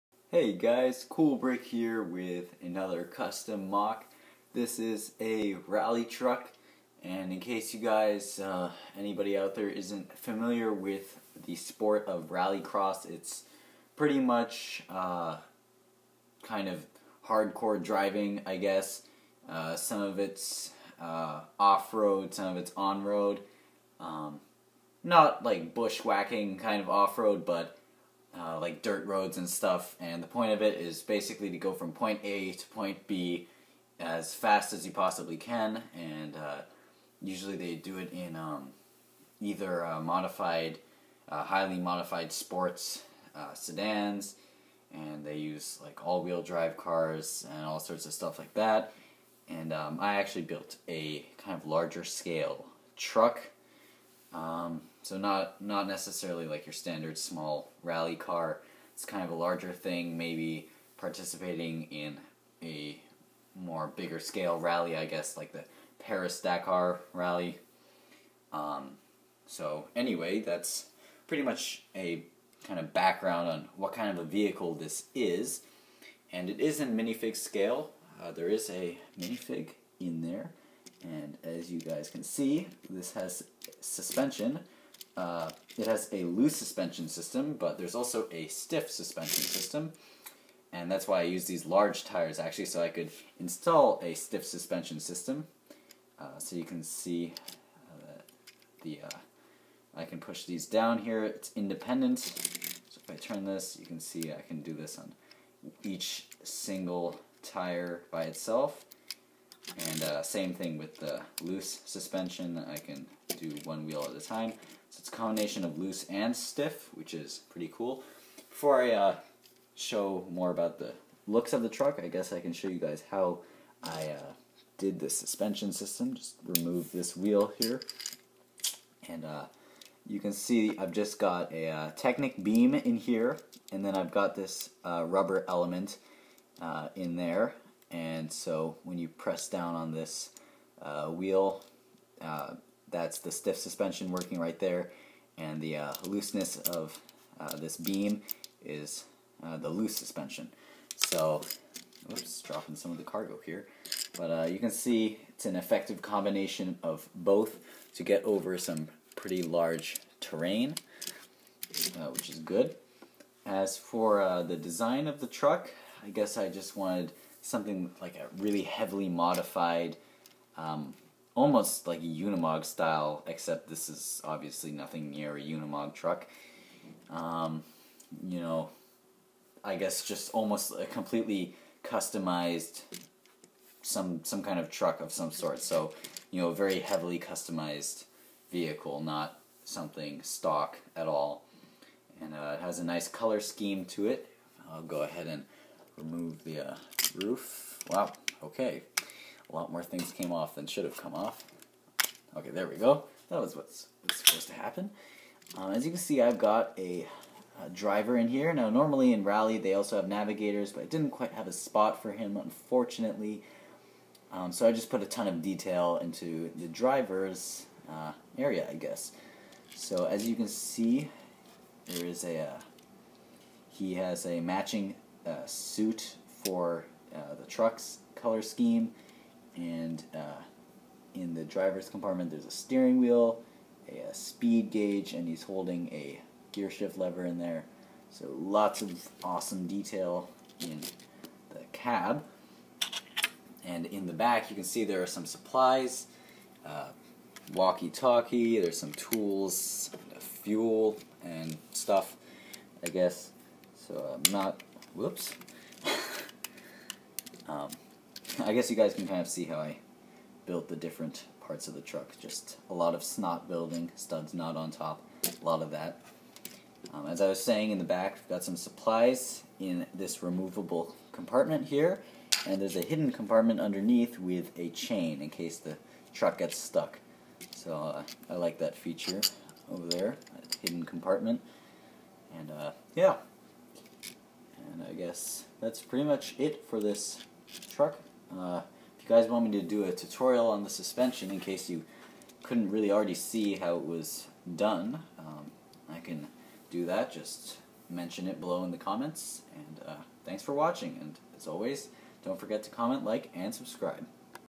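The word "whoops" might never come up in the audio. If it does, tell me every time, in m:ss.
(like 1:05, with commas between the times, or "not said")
4:14.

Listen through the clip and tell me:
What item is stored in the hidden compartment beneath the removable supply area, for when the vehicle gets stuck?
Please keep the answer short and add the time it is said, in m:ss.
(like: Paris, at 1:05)
chain, at 4:34.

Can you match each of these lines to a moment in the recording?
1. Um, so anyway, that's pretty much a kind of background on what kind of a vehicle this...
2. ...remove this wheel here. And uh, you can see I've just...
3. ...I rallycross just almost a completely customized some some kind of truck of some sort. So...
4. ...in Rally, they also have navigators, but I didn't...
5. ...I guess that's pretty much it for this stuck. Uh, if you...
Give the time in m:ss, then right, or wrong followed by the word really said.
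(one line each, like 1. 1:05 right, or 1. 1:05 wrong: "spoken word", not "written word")
1. 1:08 right
2. 2:06 right
3. 2:59 wrong: "guess", not "rallycross"
4. 3:29 right
5. 4:44 wrong: "truck", not "stuck".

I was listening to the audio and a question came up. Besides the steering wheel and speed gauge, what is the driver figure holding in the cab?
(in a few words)
gear shift lever.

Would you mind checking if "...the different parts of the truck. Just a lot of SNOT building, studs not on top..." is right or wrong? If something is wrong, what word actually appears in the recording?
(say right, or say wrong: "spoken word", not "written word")
right.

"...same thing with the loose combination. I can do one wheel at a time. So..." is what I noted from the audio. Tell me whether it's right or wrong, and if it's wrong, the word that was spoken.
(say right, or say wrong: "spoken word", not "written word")
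wrong: "suspension", not "combination".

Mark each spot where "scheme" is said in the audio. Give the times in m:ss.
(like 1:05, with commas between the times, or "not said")
3:13, 3:48.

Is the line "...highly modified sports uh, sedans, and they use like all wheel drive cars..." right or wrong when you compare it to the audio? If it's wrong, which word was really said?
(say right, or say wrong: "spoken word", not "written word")
right.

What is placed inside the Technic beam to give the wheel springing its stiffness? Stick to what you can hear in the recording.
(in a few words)
rubber element.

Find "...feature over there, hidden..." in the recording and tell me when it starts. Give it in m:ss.
4:38.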